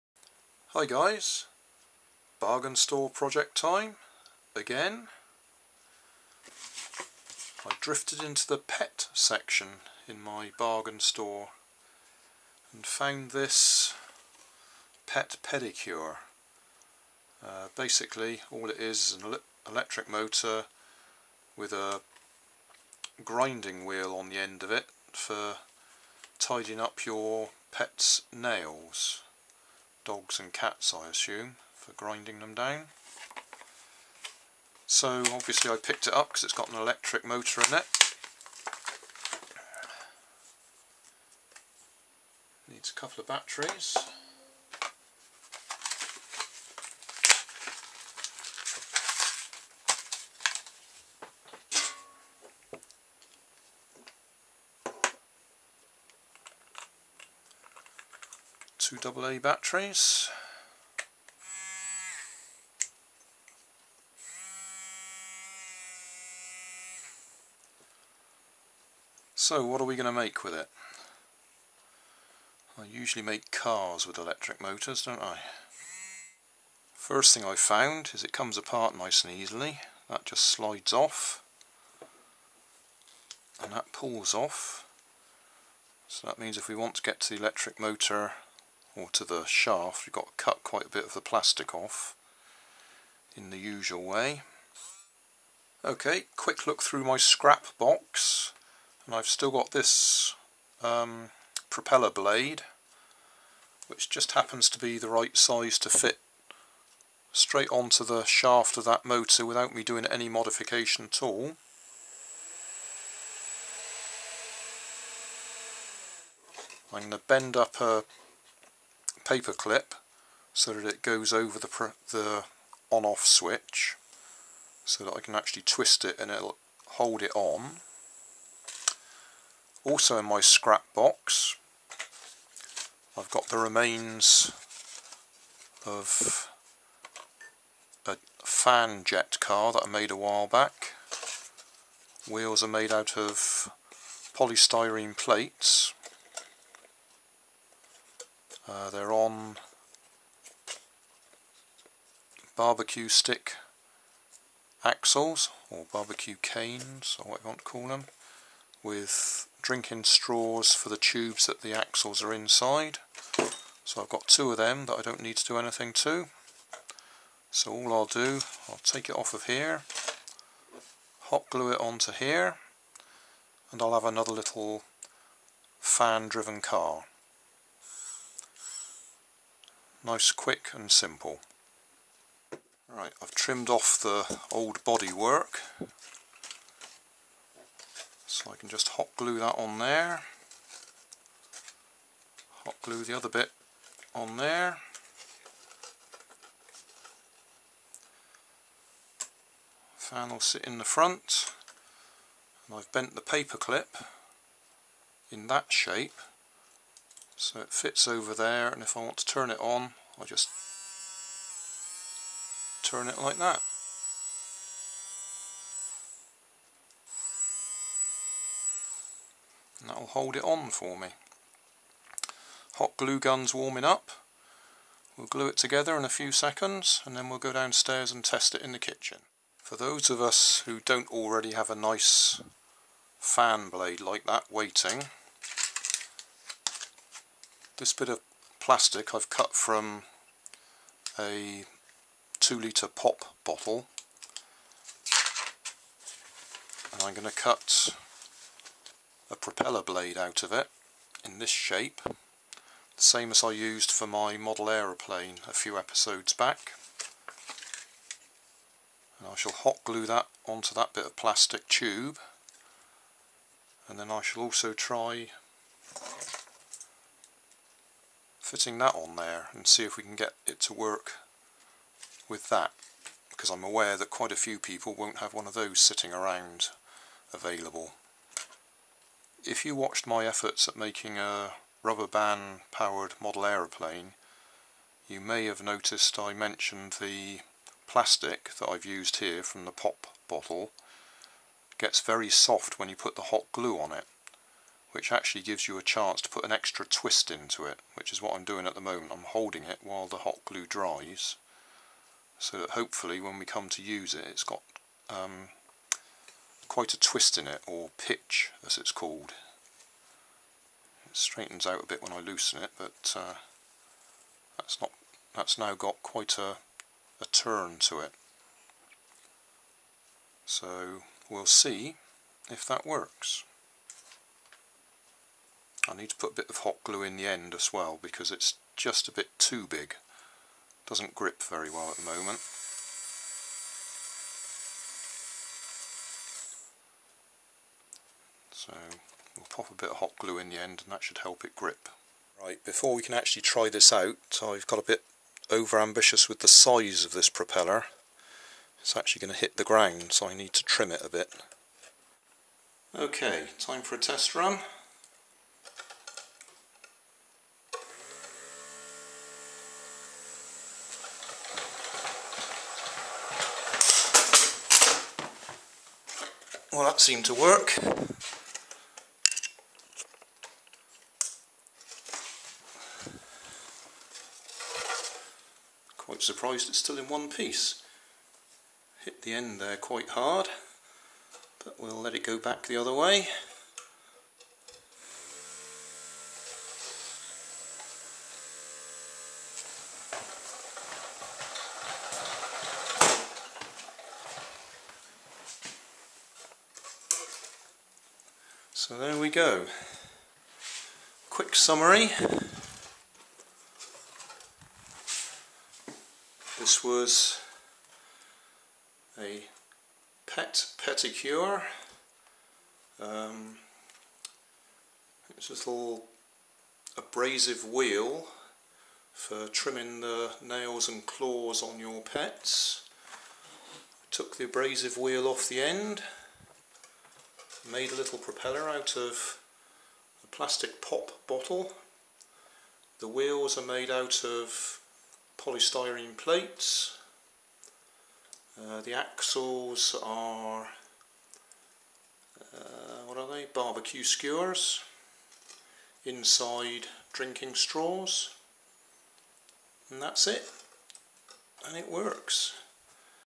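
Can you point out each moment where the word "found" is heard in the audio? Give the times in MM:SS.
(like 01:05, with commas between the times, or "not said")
00:12, 01:17.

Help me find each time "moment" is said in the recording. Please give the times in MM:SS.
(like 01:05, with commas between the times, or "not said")
04:58, 05:32.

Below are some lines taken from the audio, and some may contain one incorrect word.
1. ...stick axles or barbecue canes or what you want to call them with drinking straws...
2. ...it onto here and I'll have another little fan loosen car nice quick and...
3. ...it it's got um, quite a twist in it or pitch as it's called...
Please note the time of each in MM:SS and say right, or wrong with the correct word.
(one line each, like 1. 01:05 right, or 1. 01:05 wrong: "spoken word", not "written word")
1. 02:33 right
2. 02:51 wrong: "driven", not "loosen"
3. 05:04 right.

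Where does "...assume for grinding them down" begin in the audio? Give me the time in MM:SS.
00:31.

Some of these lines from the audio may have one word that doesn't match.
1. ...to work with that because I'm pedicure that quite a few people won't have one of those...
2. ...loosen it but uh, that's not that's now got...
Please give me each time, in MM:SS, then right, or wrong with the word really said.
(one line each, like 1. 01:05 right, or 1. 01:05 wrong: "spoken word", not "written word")
1. 04:30 wrong: "aware", not "pedicure"
2. 05:12 right.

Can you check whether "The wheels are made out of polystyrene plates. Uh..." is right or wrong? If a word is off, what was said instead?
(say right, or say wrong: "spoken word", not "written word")
right.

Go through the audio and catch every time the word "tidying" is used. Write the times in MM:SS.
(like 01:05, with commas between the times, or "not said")
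00:26.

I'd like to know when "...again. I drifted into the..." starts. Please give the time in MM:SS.
00:04.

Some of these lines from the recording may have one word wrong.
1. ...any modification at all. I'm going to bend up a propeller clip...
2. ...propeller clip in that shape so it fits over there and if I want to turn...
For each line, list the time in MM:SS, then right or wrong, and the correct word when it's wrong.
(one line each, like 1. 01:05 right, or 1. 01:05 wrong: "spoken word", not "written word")
1. 01:50 wrong: "paper", not "propeller"
2. 03:23 wrong: "paper", not "propeller".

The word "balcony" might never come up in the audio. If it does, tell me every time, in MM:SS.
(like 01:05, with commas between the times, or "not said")
not said.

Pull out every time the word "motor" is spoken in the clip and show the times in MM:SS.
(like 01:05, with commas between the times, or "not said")
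00:20, 00:37, 01:14, 01:27, 01:49.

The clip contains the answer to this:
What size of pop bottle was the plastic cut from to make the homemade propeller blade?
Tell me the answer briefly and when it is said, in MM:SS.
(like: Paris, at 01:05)
2 litre, at 04:02.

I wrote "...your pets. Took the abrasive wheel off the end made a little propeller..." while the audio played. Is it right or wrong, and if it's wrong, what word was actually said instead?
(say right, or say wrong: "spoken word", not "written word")
right.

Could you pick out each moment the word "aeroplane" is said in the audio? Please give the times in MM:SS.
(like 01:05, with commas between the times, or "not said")
04:14, 04:43.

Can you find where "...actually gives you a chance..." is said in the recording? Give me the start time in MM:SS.
04:55.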